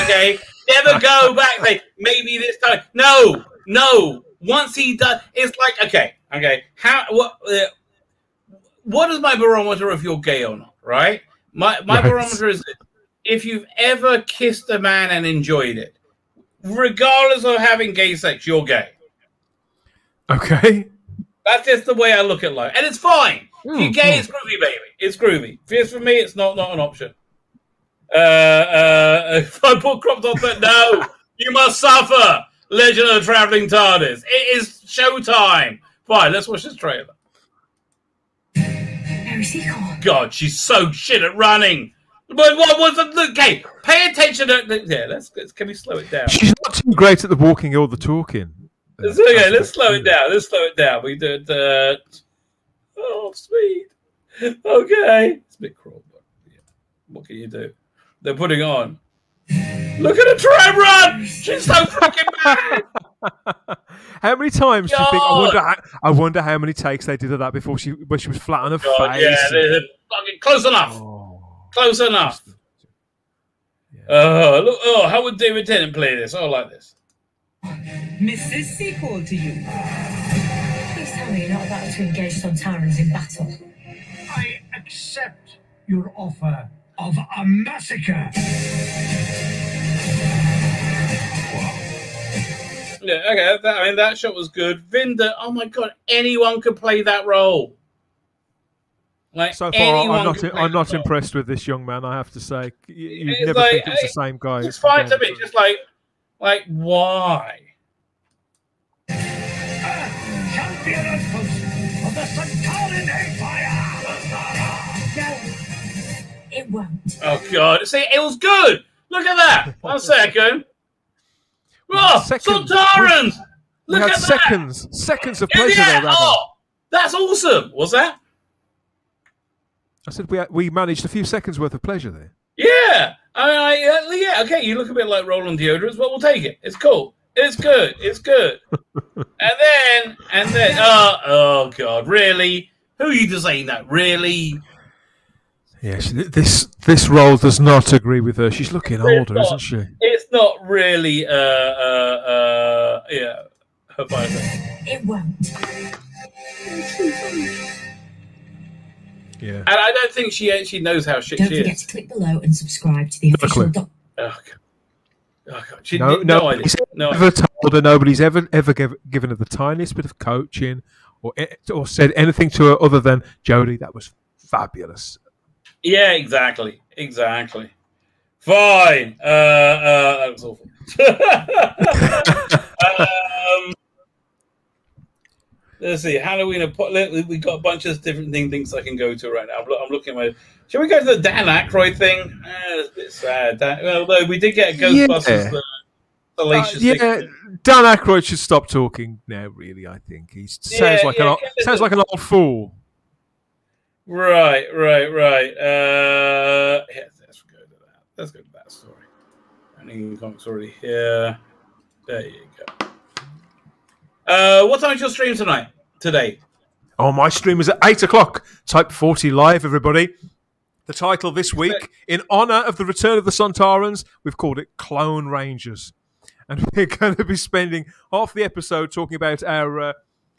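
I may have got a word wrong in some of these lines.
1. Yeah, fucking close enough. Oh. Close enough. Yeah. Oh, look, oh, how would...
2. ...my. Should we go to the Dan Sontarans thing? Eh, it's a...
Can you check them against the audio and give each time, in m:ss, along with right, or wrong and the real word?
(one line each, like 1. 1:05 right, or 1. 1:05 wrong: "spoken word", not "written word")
1. 1:09 right
2. 3:10 wrong: "Aykroyd", not "Sontarans".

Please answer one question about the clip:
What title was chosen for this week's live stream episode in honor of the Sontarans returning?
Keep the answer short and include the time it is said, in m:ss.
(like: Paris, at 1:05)
Clone Rangers, at 3:44.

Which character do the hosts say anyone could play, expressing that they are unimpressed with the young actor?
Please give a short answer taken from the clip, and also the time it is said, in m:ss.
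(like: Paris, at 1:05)
Vinder, at 1:34.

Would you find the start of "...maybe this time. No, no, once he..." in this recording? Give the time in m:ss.
0:01.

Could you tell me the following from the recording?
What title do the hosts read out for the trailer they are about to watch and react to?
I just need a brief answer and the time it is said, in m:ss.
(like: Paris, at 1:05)
Legend of the Traveling TARDIS, at 0:32.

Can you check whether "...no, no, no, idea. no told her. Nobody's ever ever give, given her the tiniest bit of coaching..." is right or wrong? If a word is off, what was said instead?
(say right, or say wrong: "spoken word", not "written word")
right.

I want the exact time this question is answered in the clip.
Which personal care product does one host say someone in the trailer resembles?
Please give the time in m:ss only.
2:15.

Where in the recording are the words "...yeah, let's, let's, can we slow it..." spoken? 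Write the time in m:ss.
0:44.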